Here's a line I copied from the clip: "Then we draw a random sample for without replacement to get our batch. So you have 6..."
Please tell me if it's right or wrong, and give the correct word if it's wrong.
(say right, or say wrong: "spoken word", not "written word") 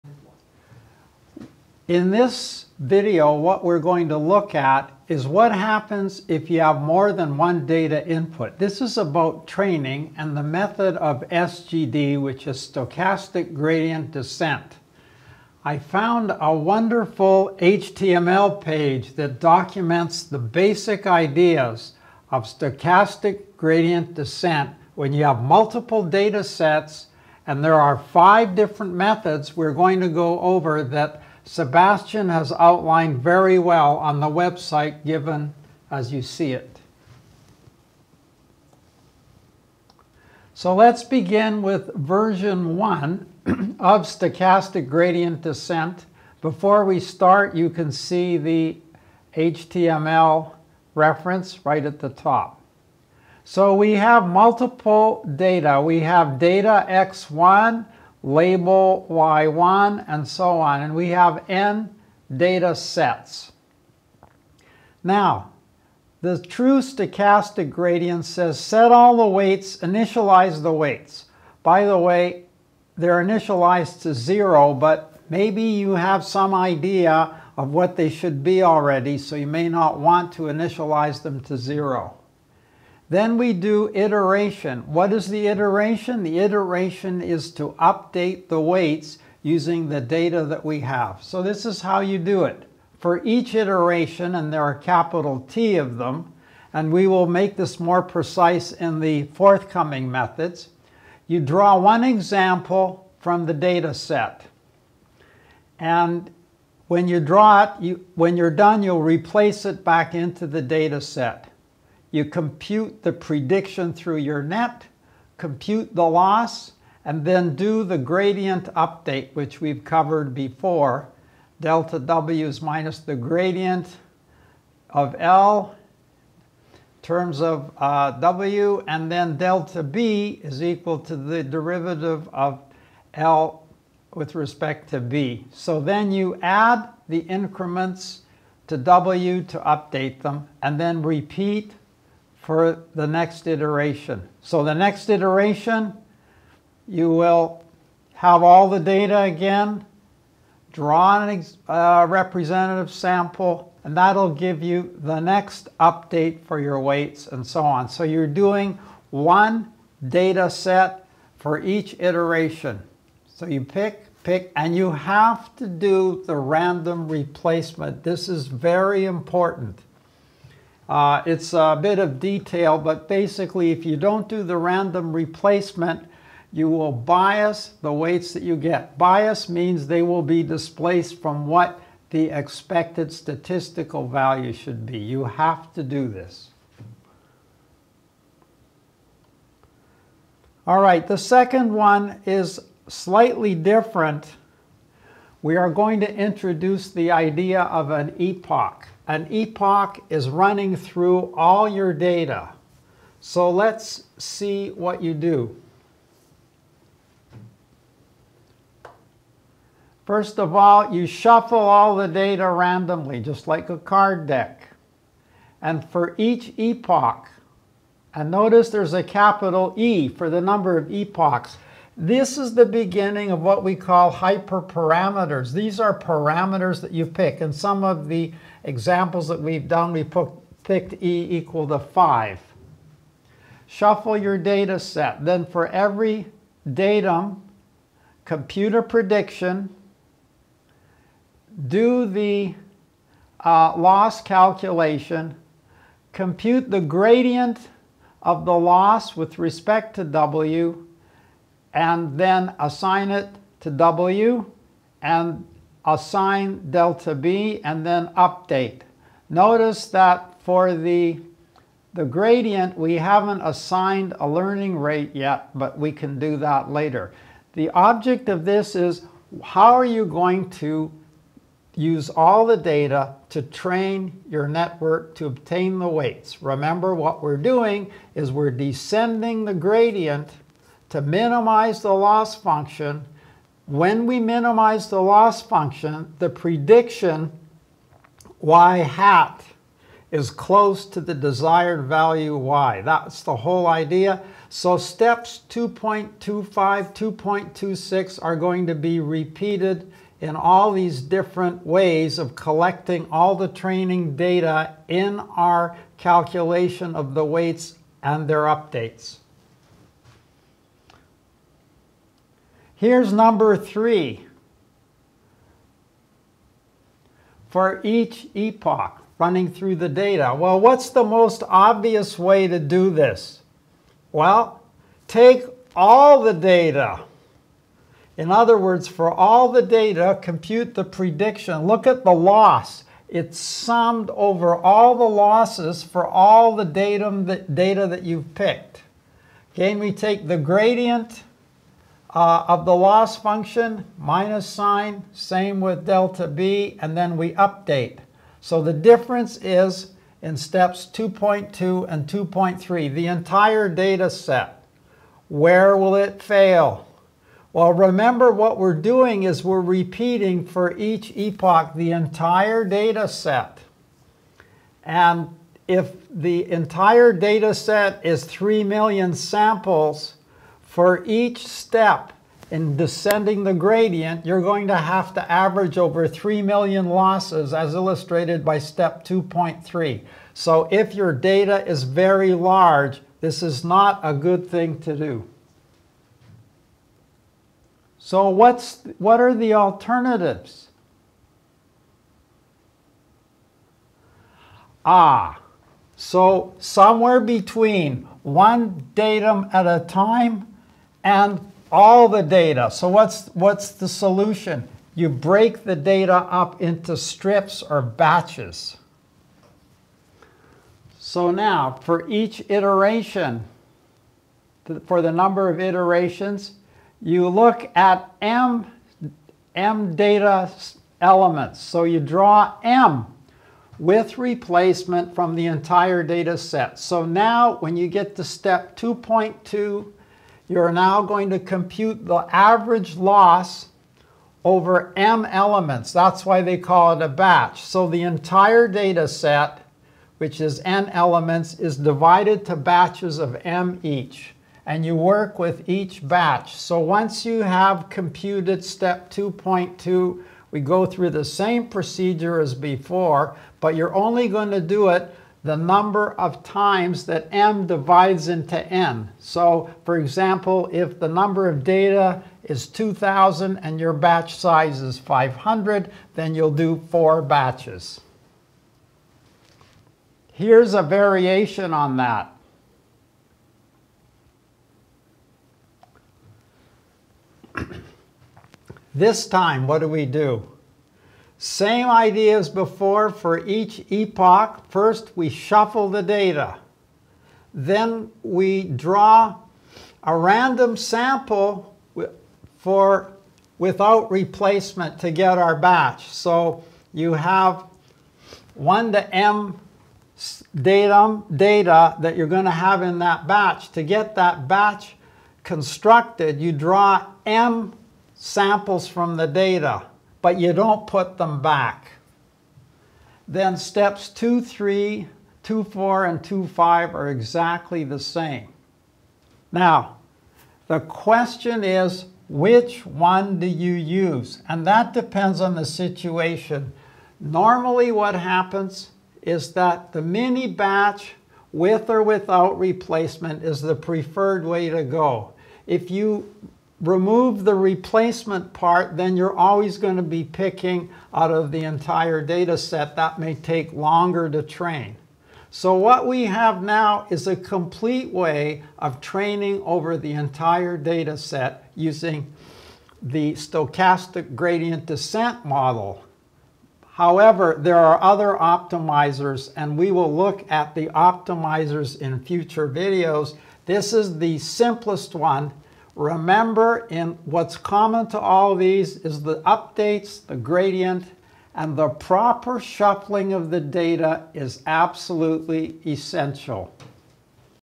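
wrong: "1", not "6".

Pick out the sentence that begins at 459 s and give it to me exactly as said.
So for example, if the number of data is 2,000 and your batch size is 500, then you'll do four batches.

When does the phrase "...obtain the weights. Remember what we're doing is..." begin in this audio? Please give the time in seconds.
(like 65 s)
275 s.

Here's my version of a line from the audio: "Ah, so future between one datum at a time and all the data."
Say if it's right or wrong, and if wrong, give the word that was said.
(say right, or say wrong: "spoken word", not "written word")
wrong: "somewhere", not "future".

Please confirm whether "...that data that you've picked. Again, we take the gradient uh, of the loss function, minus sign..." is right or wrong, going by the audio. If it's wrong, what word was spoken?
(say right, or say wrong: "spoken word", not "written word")
right.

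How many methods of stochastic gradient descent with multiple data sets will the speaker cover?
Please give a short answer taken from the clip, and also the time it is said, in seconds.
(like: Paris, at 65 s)
5, at 27 s.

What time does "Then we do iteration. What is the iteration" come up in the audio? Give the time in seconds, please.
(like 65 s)
83 s.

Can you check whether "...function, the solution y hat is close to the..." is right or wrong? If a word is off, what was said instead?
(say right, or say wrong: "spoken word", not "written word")
wrong: "prediction", not "solution".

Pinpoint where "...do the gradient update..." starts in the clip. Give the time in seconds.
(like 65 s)
117 s.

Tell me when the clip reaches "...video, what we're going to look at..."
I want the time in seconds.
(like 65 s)
2 s.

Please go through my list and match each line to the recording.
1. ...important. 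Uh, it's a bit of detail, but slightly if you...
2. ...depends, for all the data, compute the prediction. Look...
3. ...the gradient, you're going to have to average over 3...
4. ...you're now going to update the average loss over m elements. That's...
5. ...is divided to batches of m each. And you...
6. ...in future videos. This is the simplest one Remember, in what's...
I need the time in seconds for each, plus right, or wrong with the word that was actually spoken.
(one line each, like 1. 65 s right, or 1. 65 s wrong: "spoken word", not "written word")
1. 169 s wrong: "basically", not "slightly"
2. 328 s wrong: "words", not "depends"
3. 373 s right
4. 430 s wrong: "compute", not "update"
5. 441 s right
6. 561 s right.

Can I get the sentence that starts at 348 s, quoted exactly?
So the difference is in steps 2.2 and 2.3, the entire data set.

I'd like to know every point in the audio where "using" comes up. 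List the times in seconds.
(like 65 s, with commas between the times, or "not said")
89 s, 551 s.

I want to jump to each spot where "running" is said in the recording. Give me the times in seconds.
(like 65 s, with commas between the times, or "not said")
200 s, 319 s.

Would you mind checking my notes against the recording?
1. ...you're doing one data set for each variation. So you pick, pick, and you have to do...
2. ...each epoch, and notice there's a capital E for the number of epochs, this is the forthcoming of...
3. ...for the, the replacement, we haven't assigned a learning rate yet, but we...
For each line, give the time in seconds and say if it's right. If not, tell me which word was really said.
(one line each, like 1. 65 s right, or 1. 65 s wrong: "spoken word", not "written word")
1. 158 s wrong: "iteration", not "variation"
2. 216 s wrong: "beginning", not "forthcoming"
3. 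260 s wrong: "gradient", not "replacement".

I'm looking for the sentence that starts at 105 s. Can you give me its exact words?
And when you draw it, you, when you're done, you'll replace it back into the data set.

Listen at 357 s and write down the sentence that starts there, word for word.
Well, remember what we're doing is we're repeating for each epoch the entire data set.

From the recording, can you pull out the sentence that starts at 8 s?
This is about training and the method of SGD, which is stochastic gradient descent.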